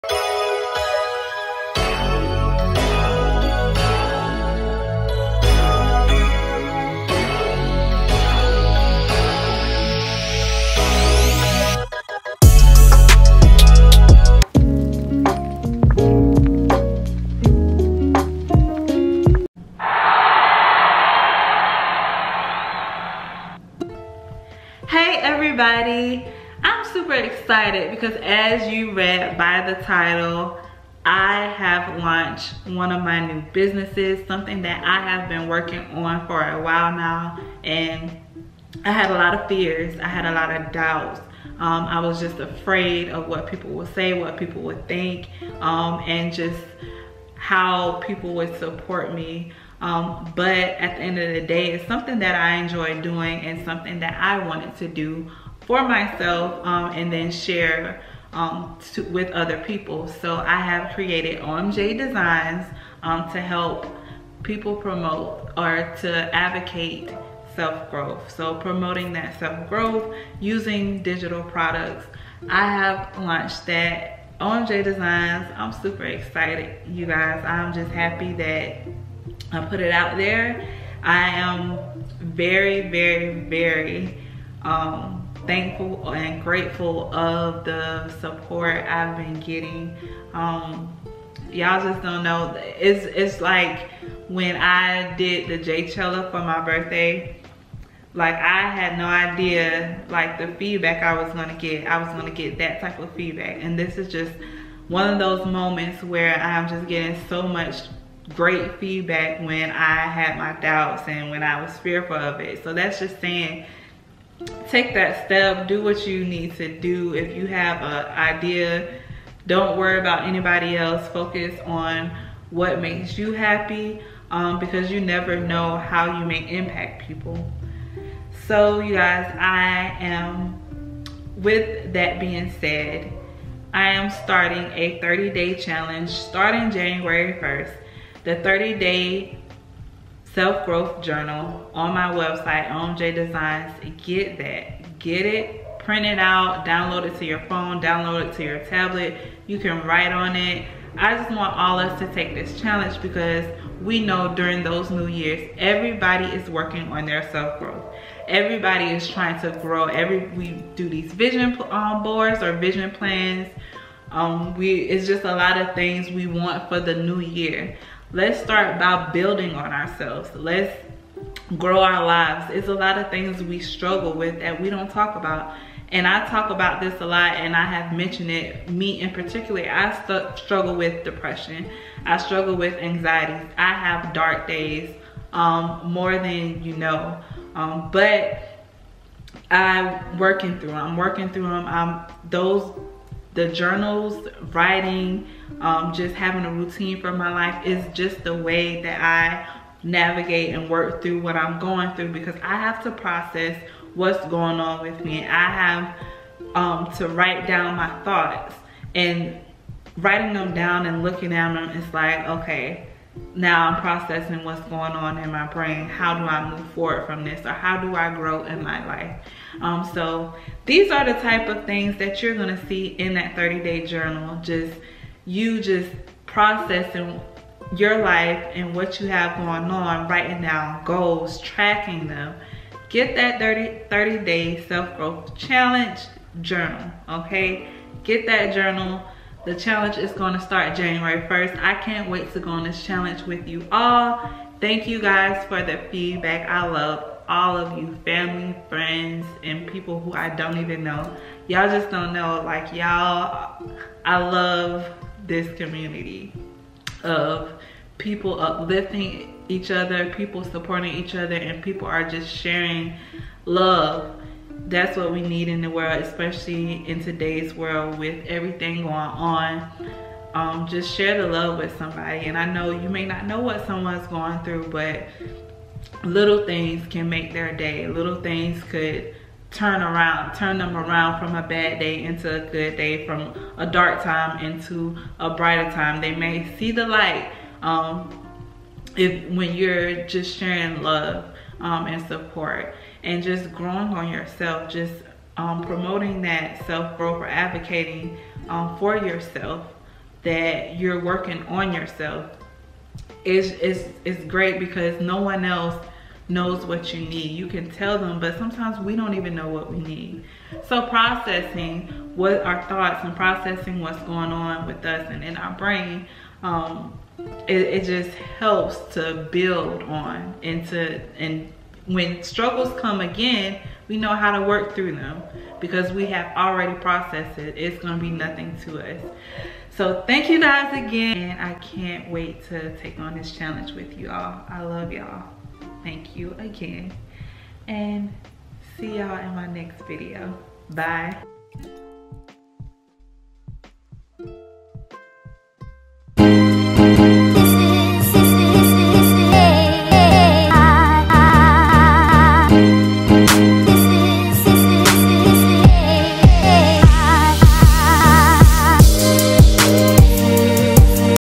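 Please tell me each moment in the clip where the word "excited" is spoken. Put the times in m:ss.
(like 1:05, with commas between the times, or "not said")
0:27, 1:16.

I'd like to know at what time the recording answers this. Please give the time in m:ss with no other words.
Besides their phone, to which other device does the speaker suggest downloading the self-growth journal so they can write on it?
2:28.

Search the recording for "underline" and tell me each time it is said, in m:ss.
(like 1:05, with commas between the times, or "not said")
not said.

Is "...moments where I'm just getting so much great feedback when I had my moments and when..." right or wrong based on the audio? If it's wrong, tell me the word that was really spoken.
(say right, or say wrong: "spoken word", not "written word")
wrong: "doubts", not "moments".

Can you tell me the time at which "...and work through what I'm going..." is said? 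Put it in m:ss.
3:20.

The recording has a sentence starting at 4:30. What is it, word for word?
Um, just share the love with somebody.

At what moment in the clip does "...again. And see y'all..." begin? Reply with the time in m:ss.
5:36.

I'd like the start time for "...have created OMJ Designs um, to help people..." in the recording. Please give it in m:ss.
1:00.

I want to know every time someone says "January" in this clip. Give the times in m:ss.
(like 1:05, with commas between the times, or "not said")
2:16, 4:00.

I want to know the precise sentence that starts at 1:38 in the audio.
Like I had no idea like the feedback I was gonna get.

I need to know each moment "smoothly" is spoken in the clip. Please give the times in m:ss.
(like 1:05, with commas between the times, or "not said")
not said.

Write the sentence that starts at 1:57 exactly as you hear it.
If you have an idea, don't worry about anybody else.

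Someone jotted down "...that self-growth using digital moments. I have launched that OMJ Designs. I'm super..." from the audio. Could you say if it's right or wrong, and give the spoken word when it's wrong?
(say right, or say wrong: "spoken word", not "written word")
wrong: "products", not "moments".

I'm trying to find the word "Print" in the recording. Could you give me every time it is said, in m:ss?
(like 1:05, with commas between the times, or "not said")
2:25.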